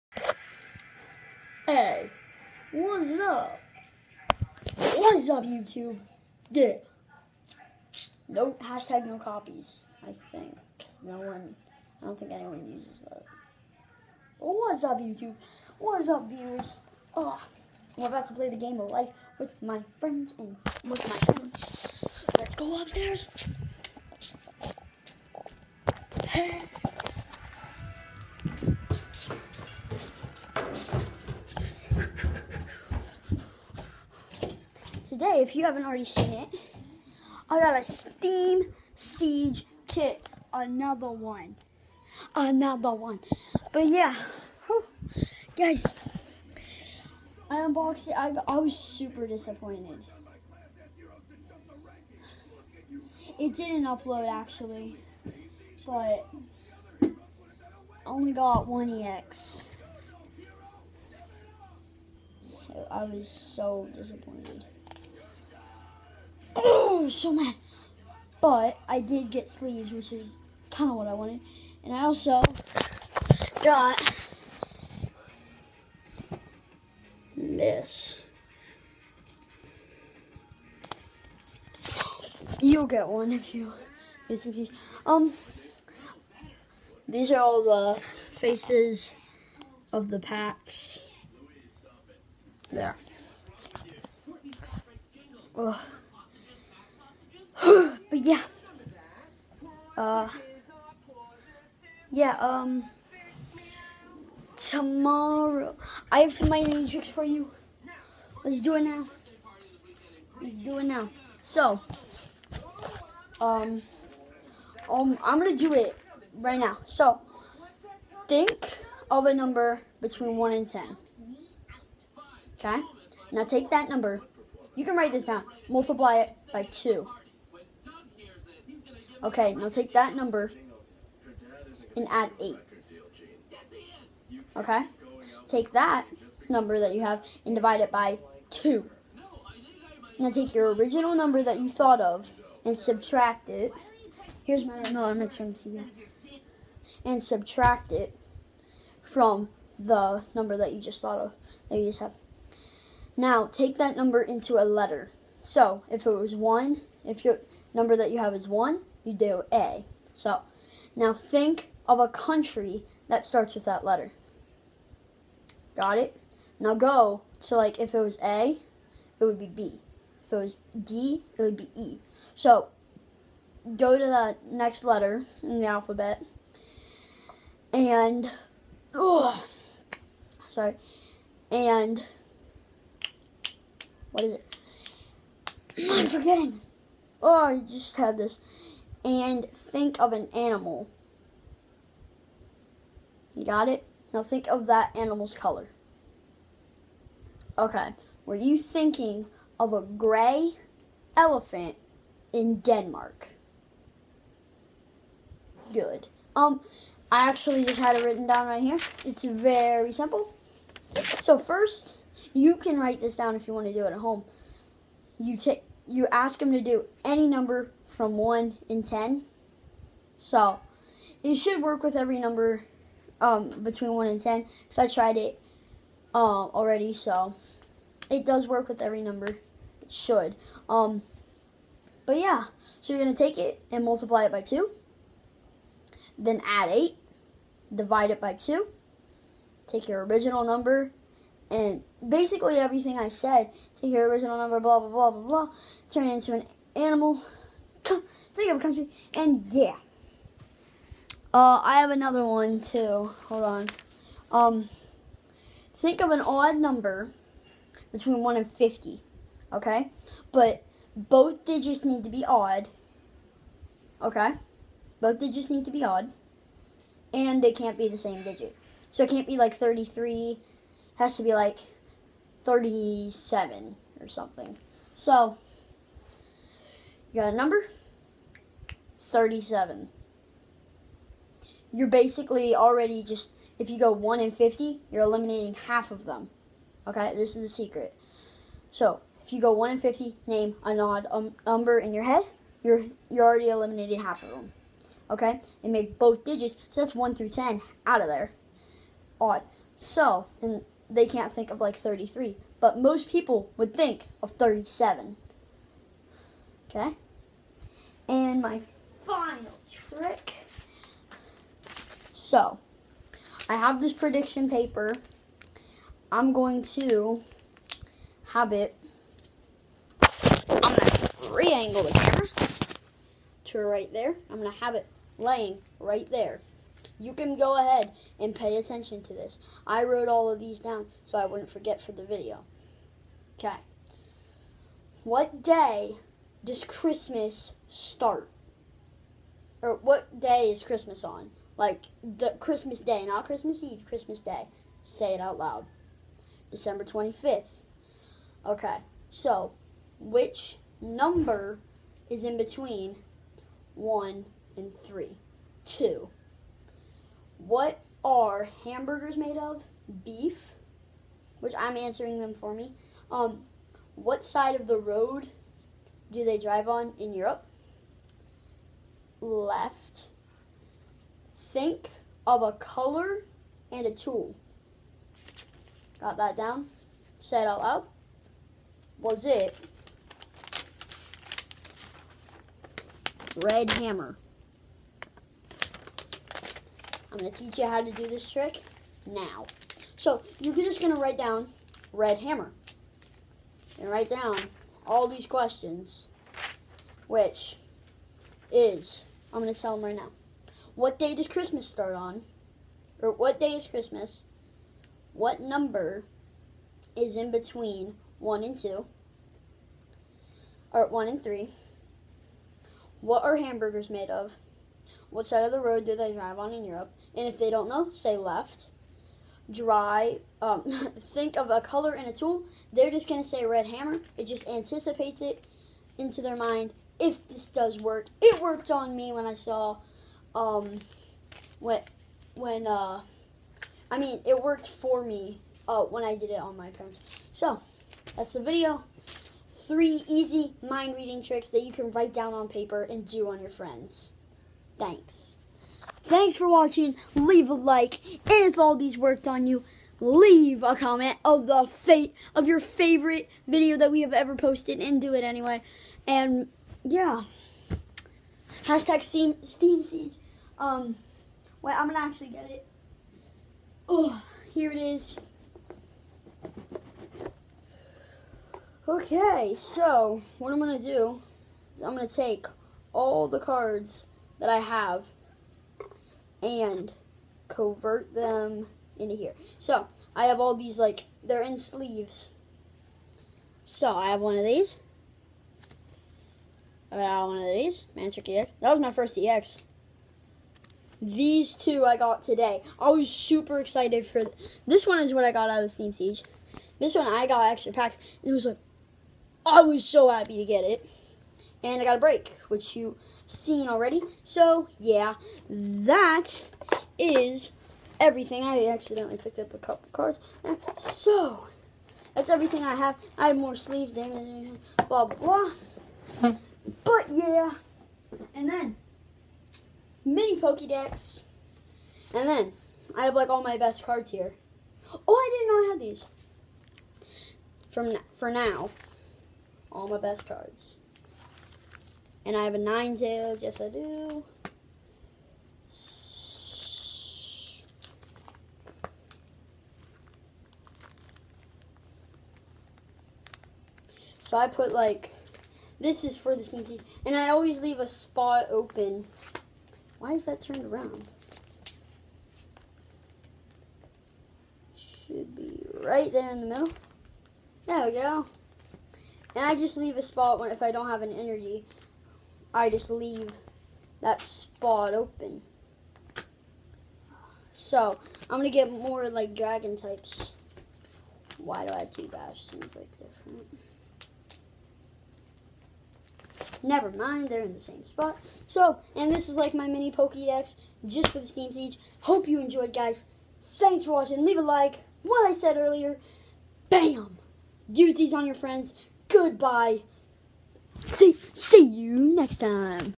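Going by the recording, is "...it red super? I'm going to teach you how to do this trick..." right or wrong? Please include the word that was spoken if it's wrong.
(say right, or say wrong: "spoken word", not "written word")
wrong: "hammer", not "super".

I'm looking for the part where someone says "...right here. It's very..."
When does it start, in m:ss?
3:28.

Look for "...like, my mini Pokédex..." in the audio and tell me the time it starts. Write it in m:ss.
9:39.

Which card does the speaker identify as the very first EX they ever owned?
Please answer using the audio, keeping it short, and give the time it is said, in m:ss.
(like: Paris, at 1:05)
Manectric EX, at 8:07.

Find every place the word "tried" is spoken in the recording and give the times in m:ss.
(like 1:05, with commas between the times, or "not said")
3:44.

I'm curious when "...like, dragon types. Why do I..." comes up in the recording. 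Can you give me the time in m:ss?
9:29.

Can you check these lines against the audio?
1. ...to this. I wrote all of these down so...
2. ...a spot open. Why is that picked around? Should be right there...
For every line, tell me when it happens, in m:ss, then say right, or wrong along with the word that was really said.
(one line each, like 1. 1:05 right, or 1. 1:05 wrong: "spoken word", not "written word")
1. 5:29 right
2. 9:07 wrong: "turned", not "picked".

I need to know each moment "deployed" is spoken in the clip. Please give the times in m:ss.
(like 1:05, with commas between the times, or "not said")
not said.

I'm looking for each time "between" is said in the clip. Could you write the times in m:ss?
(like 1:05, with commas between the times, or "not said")
2:00, 3:43, 4:17, 5:52, 6:47.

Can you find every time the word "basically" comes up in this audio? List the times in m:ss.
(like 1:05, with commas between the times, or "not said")
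4:02, 4:41.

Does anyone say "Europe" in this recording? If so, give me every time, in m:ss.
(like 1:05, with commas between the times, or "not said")
6:07, 6:56.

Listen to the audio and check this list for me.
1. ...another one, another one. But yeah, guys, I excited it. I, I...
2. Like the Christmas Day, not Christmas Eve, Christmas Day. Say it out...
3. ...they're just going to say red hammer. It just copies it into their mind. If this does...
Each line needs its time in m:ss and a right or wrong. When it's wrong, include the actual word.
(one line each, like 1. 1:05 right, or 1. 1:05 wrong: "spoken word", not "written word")
1. 0:40 wrong: "unboxed", not "excited"
2. 5:41 right
3. 7:02 wrong: "anticipates", not "copies".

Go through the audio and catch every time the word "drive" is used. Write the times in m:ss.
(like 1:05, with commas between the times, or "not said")
6:06, 6:56.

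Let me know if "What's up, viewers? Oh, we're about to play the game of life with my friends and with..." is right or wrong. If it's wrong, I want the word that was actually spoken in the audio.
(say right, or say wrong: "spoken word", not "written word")
right.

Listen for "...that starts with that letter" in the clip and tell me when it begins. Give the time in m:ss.
2:43.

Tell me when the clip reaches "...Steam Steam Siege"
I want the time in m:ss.
7:39.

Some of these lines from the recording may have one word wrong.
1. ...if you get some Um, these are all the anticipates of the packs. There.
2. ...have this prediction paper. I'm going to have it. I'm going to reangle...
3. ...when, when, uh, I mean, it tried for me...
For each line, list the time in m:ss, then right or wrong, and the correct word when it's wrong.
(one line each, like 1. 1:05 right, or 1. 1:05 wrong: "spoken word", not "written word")
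1. 1:23 wrong: "faces", not "anticipates"
2. 5:13 right
3. 7:11 wrong: "worked", not "tried".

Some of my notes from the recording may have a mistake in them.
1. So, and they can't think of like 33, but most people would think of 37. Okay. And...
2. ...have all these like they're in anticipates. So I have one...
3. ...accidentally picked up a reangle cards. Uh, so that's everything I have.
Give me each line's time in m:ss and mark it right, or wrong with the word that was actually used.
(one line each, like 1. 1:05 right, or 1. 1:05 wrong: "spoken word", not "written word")
1. 4:59 right
2. 8:00 wrong: "sleeves", not "anticipates"
3. 8:28 wrong: "couple", not "reangle".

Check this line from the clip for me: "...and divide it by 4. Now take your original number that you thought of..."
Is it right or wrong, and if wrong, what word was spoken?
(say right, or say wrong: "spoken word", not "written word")
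wrong: "2", not "4".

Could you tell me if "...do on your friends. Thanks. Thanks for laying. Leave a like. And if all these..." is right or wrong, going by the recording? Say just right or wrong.
wrong.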